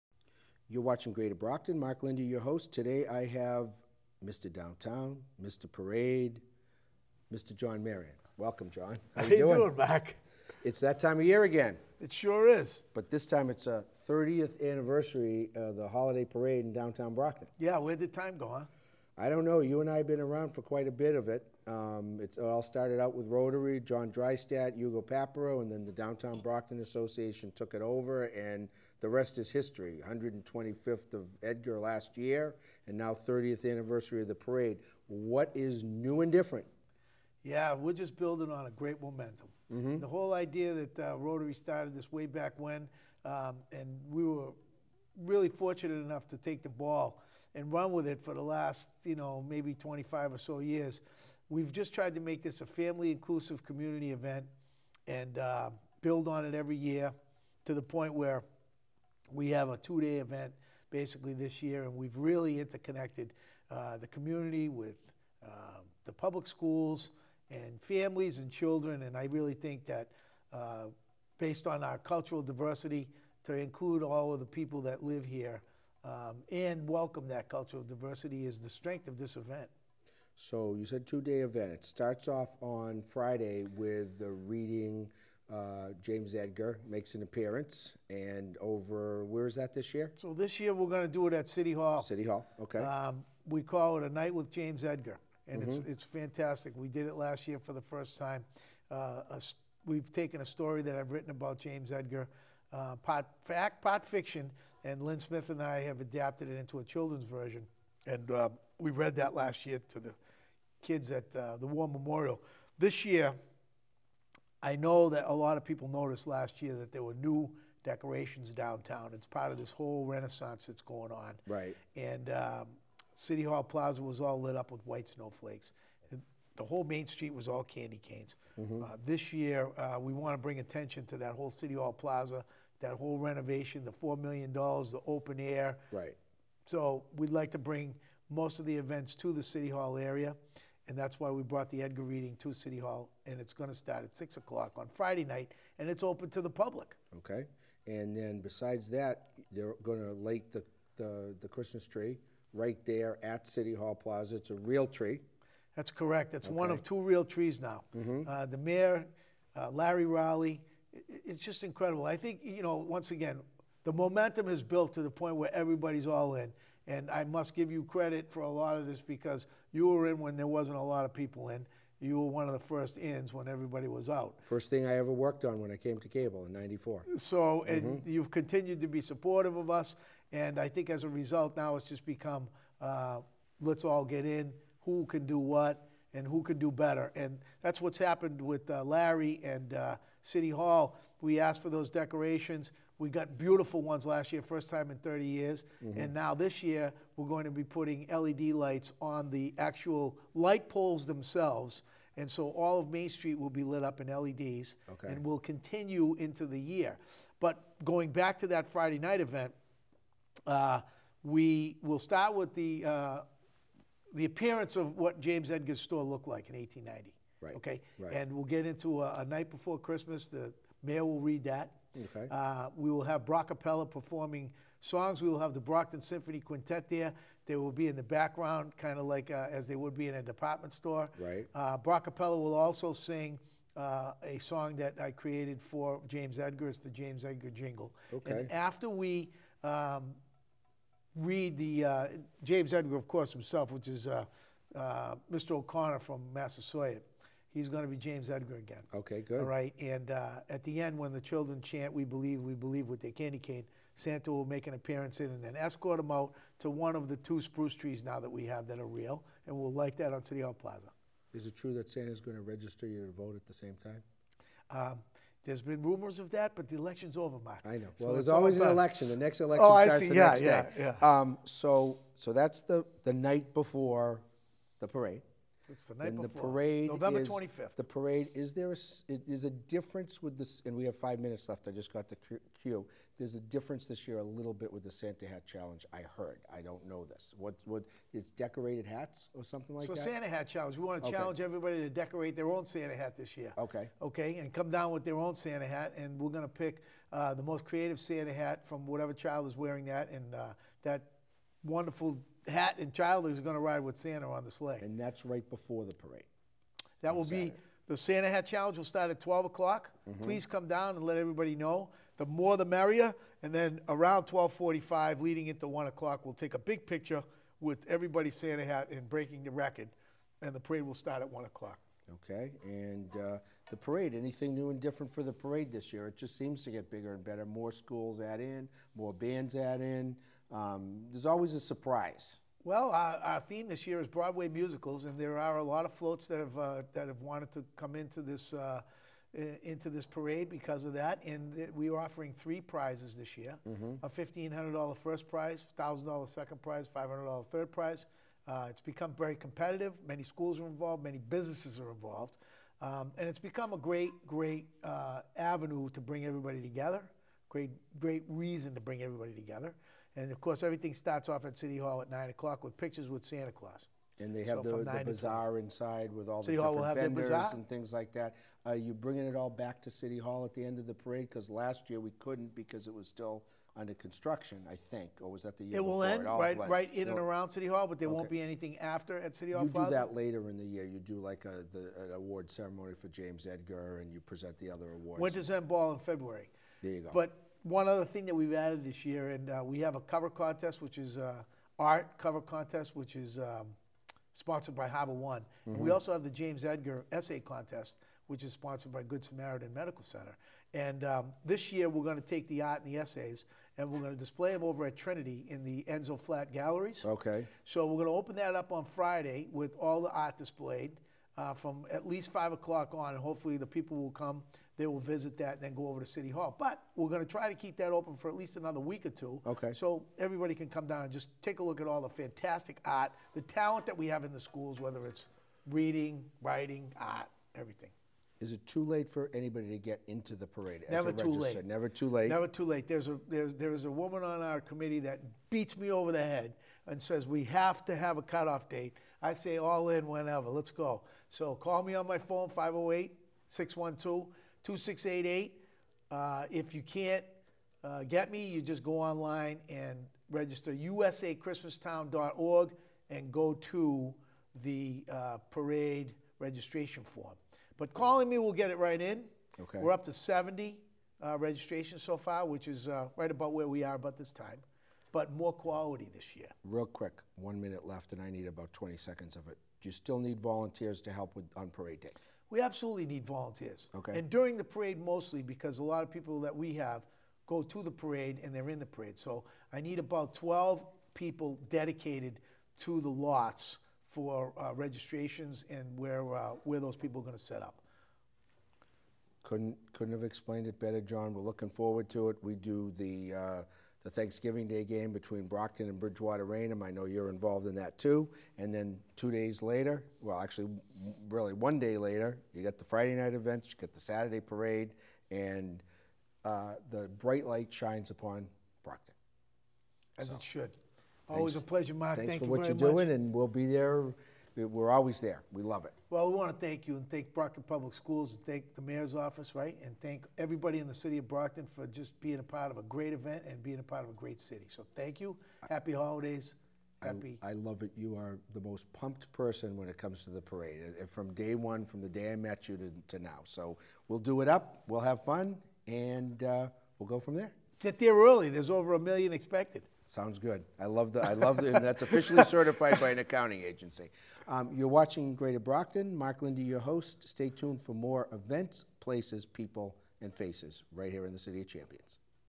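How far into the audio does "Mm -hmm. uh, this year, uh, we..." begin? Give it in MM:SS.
02:08.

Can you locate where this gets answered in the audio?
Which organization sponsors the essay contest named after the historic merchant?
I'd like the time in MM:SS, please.
06:39.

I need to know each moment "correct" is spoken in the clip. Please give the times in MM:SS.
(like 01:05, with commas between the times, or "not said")
02:35.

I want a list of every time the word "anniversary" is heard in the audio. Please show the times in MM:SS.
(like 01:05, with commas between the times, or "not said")
00:14, 00:33.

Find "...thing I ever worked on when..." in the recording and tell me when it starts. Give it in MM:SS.
02:54.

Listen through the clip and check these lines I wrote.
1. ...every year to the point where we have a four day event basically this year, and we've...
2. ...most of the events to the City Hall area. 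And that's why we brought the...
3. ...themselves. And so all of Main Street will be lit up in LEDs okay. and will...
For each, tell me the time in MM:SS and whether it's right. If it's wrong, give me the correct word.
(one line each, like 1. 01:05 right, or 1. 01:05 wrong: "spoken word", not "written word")
1. 00:56 wrong: "two", not "four"
2. 02:18 right
3. 03:21 right.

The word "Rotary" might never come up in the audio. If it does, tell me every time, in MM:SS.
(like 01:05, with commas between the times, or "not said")
00:23, 00:41.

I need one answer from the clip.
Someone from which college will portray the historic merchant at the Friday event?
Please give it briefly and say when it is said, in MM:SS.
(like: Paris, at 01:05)
Massasoit, at 04:06.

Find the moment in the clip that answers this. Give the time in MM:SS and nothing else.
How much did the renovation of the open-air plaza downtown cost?
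02:13.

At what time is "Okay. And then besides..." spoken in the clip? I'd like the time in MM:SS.
02:27.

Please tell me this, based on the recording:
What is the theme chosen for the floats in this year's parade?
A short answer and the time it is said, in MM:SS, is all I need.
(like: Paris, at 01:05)
Broadway musicals, at 05:34.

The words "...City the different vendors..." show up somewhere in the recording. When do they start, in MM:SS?
06:06.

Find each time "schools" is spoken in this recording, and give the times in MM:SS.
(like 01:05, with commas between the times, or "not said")
01:06, 05:27, 05:50, 07:04, 08:37.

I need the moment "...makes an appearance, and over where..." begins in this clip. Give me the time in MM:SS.
01:26.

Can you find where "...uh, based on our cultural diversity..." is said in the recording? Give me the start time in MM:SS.
01:10.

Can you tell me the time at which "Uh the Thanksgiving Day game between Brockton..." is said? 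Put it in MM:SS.
08:13.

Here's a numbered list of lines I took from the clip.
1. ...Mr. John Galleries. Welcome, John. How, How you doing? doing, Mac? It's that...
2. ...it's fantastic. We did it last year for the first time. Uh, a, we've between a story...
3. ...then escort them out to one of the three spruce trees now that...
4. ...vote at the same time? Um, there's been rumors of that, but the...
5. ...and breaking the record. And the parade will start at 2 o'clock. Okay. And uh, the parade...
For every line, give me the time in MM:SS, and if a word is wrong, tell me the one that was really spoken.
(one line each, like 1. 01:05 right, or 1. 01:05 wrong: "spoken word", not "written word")
1. 00:07 wrong: "Merian", not "Galleries"
2. 01:36 wrong: "taken", not "between"
3. 04:15 wrong: "two", not "three"
4. 04:23 right
5. 05:18 wrong: "1", not "2".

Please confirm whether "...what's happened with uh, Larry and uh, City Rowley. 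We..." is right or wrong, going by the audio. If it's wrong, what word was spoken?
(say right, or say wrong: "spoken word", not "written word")
wrong: "Hall", not "Rowley".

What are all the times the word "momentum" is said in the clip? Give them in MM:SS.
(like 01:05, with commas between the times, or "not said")
00:39, 02:43.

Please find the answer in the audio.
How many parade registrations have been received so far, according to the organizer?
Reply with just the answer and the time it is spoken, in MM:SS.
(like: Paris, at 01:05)
70, at 07:40.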